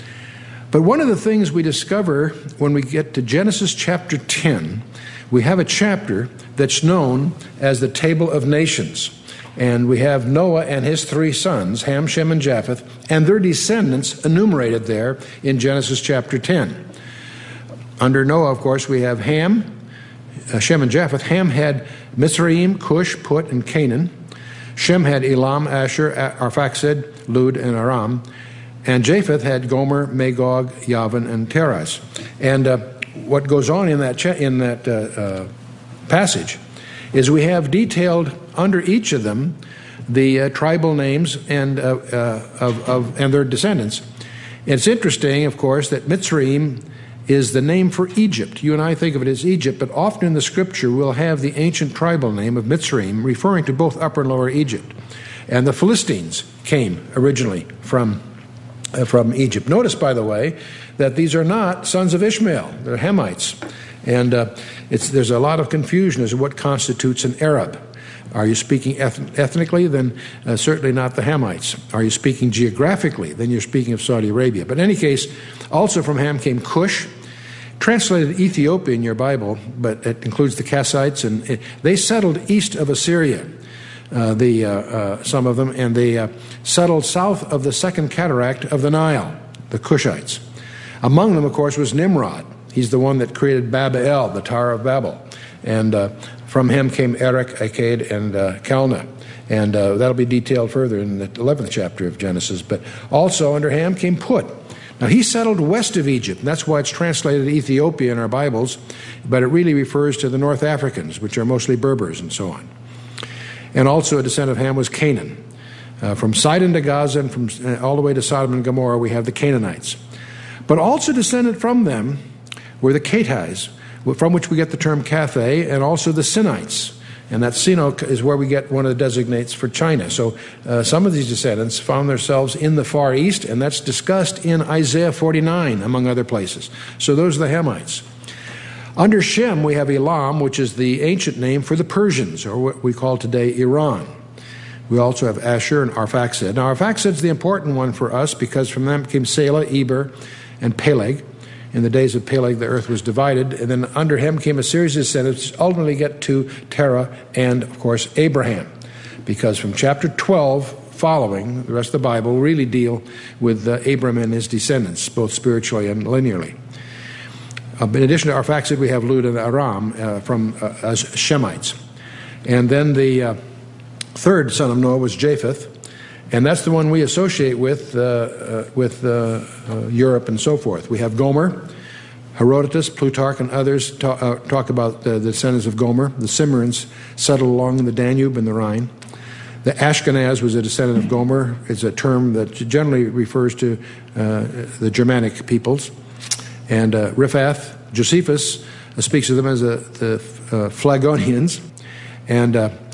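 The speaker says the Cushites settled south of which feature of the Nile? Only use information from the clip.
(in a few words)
Second Cataract.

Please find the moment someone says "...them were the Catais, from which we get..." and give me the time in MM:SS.
02:01.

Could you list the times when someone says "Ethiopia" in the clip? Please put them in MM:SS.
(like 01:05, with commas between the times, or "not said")
01:18, 01:47.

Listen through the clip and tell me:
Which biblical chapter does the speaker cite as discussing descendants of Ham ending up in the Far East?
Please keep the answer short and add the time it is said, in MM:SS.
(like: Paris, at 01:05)
Isaiah 49, at 02:14.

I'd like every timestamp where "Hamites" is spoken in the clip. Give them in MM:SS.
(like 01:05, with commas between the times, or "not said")
01:02, 01:11, 02:17.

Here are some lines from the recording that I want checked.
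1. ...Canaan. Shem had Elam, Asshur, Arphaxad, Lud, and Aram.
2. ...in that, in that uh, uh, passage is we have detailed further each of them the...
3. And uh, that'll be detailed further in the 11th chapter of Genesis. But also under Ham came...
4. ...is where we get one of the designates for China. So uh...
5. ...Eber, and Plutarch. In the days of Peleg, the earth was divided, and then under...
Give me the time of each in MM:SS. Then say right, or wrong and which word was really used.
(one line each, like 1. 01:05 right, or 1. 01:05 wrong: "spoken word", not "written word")
1. 00:23 right
2. 00:33 wrong: "under", not "further"
3. 01:39 right
4. 02:07 right
5. 02:29 wrong: "Peleg", not "Plutarch".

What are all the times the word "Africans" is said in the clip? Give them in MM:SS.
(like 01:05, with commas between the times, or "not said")
01:50.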